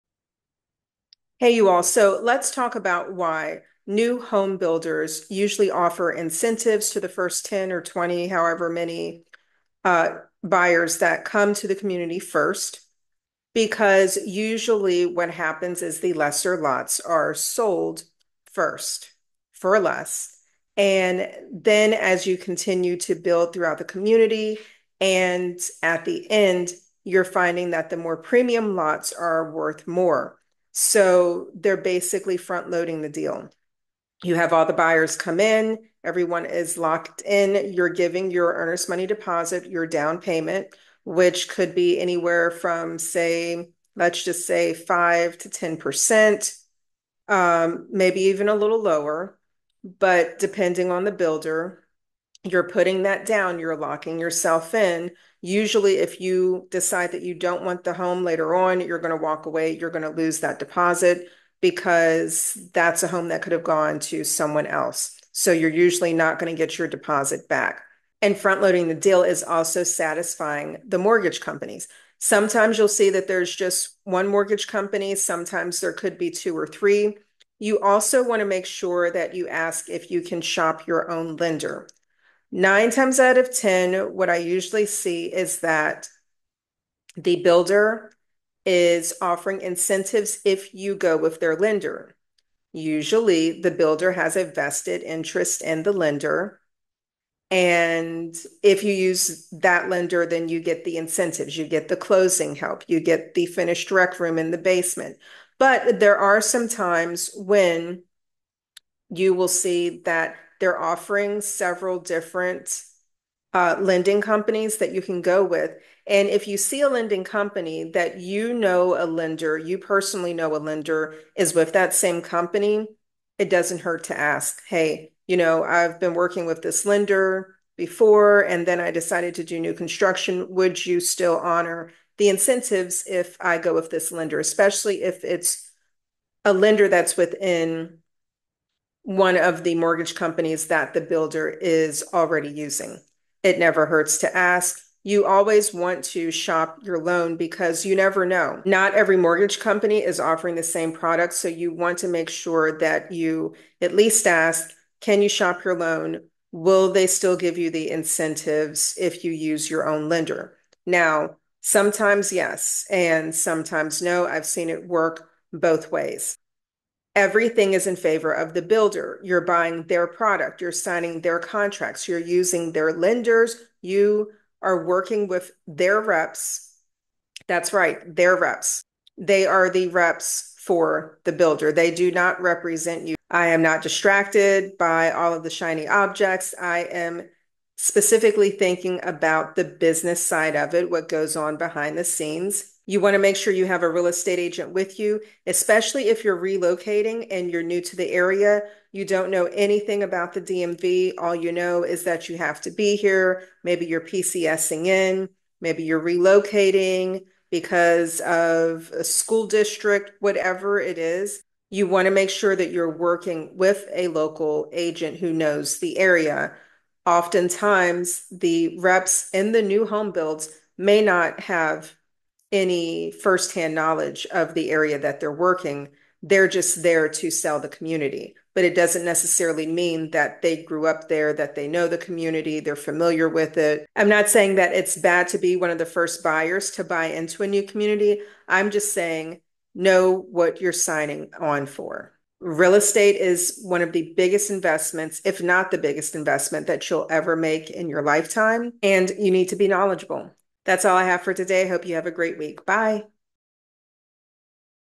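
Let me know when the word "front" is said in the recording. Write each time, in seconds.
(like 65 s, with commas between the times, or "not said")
32 s, 68 s.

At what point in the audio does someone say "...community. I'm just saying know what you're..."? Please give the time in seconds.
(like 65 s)
237 s.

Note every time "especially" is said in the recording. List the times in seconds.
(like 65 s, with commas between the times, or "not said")
134 s, 195 s.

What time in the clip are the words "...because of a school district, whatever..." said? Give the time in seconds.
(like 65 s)
207 s.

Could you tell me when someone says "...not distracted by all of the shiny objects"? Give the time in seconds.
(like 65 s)
183 s.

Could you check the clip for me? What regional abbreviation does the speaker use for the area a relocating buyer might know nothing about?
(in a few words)
DMV.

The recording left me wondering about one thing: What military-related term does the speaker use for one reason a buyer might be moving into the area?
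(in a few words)
PCSing.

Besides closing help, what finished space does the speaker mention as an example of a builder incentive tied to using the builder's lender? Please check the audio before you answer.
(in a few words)
rec room in the basement.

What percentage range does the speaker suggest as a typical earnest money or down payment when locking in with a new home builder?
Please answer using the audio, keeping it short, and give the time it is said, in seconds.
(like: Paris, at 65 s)
5 to 10%, at 44 s.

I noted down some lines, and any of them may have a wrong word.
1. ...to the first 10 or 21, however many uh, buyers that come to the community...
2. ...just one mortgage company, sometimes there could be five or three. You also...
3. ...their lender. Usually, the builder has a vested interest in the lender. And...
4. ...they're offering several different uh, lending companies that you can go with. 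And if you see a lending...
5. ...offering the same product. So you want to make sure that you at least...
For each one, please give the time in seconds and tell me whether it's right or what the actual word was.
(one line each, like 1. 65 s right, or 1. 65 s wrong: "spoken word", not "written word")
1. 6 s wrong: "20", not "21"
2. 73 s wrong: "two", not "five"
3. 91 s right
4. 110 s right
5. 150 s right.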